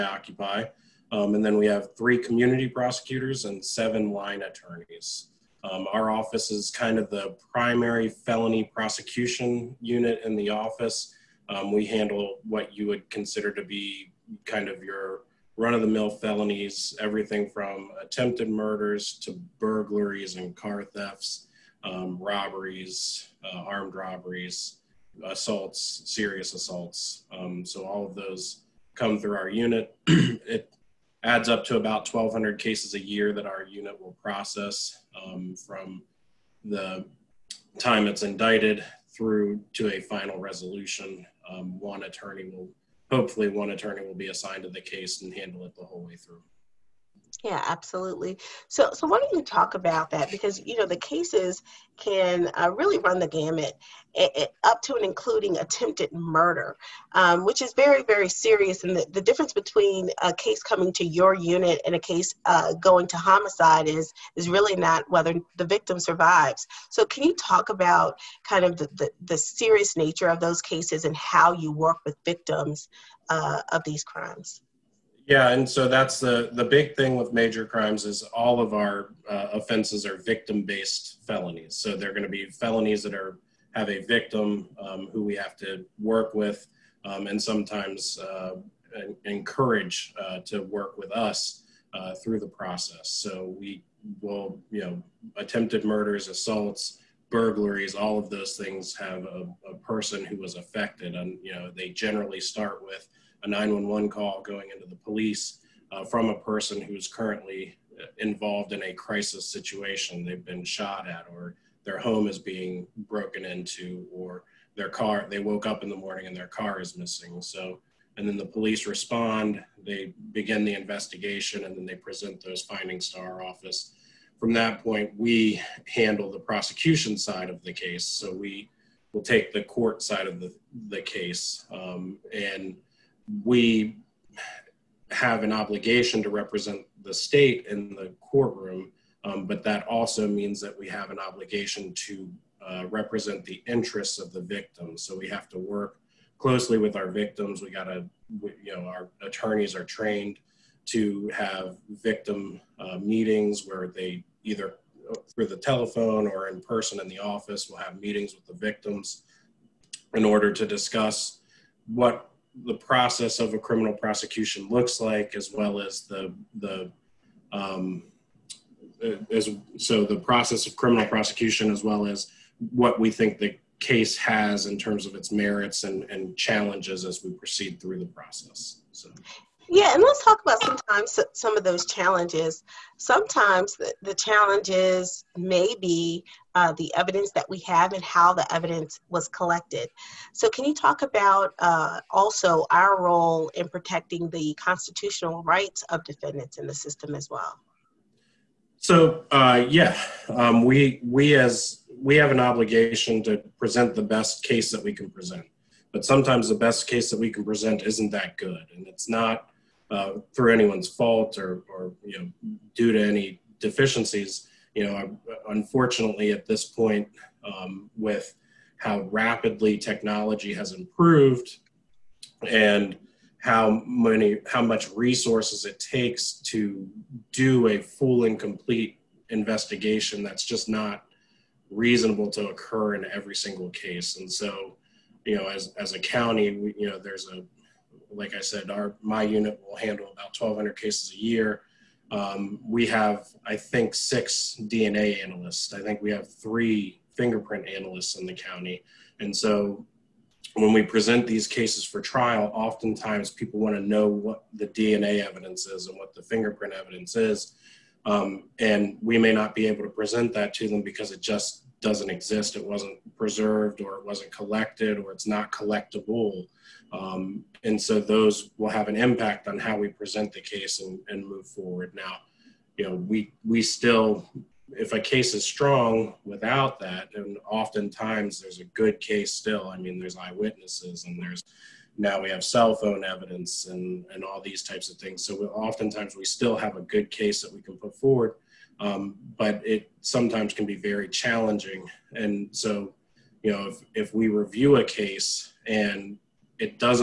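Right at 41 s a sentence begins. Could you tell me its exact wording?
Um, one attorney will, hopefully, one attorney will be assigned to the case and handle it the whole way through.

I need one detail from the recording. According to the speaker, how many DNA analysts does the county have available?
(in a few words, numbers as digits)
6.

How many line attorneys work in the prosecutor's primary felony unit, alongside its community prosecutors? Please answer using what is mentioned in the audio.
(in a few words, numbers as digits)
7.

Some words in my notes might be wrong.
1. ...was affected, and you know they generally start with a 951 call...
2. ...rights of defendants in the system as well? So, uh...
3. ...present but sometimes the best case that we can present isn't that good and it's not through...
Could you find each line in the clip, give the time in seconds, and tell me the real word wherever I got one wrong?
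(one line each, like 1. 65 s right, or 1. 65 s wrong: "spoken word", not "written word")
1. 100 s wrong: "911", not "951"
2. 195 s right
3. 205 s right.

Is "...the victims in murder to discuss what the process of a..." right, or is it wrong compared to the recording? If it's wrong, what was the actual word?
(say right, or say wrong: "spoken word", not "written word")
wrong: "order", not "murder".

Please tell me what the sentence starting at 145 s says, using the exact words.
So we have to work closely with our victims.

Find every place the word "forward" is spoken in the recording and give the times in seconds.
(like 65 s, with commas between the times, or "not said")
271 s, 287 s.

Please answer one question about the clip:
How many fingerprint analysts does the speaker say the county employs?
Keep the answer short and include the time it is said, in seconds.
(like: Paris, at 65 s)
3, at 246 s.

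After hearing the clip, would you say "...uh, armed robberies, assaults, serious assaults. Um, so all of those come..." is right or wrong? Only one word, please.
right.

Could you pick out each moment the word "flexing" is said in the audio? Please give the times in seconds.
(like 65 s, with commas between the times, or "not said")
not said.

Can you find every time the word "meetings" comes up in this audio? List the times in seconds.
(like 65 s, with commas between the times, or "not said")
152 s, 157 s.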